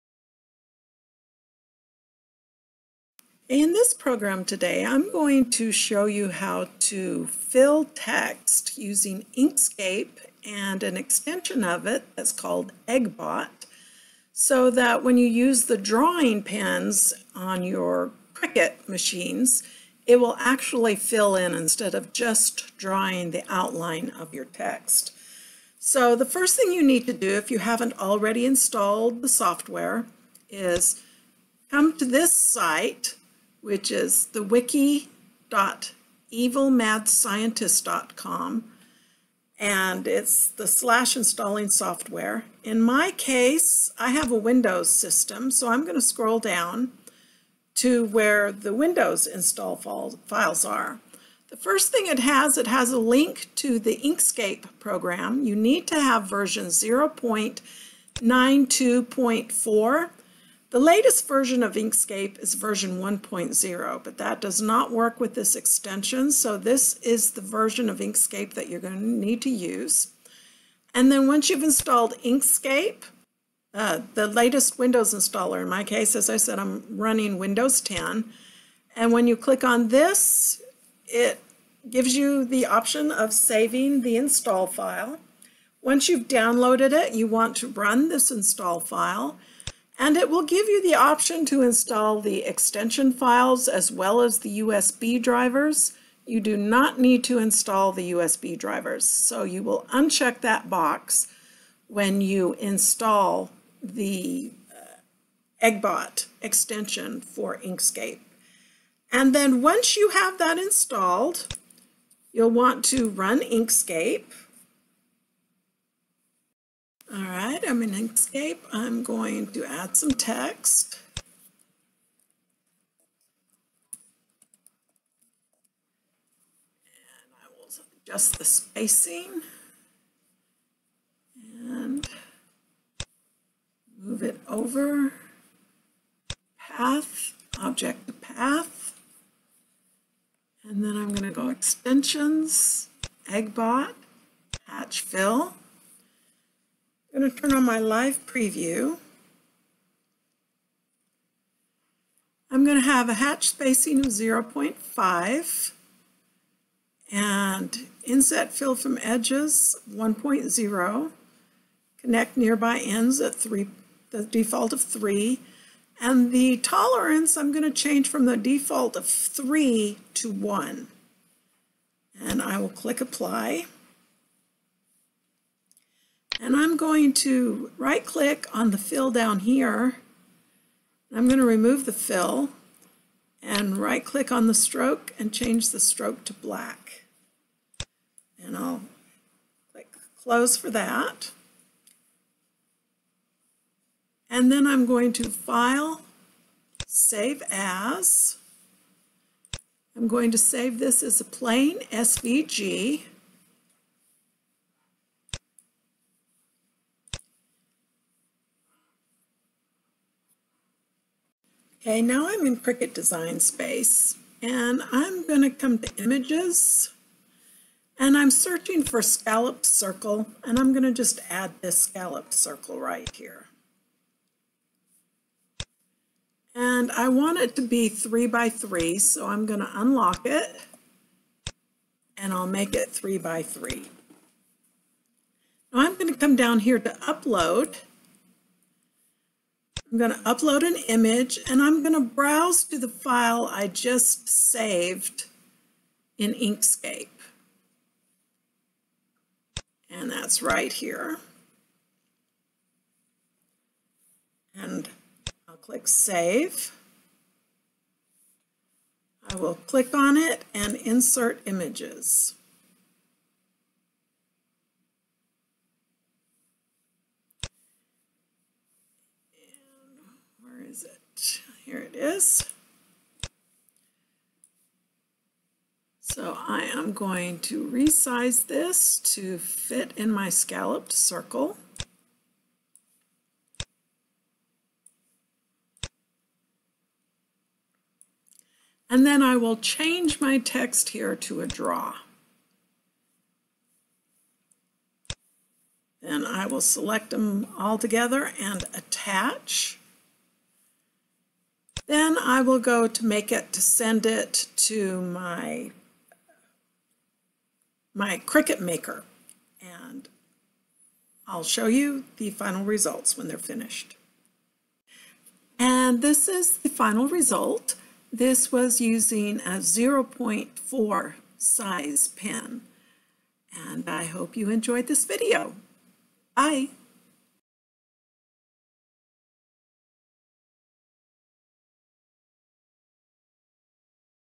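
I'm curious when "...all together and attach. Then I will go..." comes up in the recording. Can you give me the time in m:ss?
4:57.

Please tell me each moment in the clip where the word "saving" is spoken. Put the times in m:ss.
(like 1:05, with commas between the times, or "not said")
1:23.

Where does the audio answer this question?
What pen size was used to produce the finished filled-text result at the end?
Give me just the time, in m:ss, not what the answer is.
5:19.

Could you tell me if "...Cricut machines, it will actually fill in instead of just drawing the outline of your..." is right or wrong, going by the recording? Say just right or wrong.
right.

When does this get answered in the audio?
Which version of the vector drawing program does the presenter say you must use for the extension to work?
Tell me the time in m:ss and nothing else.
0:56.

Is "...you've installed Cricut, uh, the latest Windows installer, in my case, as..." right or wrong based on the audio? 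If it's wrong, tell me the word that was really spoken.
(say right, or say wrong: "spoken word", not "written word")
wrong: "Inkscape", not "Cricut".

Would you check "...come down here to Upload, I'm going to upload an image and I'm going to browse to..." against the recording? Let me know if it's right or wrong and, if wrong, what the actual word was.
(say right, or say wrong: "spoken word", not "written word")
right.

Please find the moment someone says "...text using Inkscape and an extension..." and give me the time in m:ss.
0:07.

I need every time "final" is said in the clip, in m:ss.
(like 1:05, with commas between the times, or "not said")
5:12, 5:16.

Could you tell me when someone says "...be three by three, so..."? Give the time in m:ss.
3:47.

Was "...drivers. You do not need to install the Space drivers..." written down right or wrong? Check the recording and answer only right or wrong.
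wrong.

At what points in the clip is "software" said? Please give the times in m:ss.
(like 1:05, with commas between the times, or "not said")
0:29, 0:41.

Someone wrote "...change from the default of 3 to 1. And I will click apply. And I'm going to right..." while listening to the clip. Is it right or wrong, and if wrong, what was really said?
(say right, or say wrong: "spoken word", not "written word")
right.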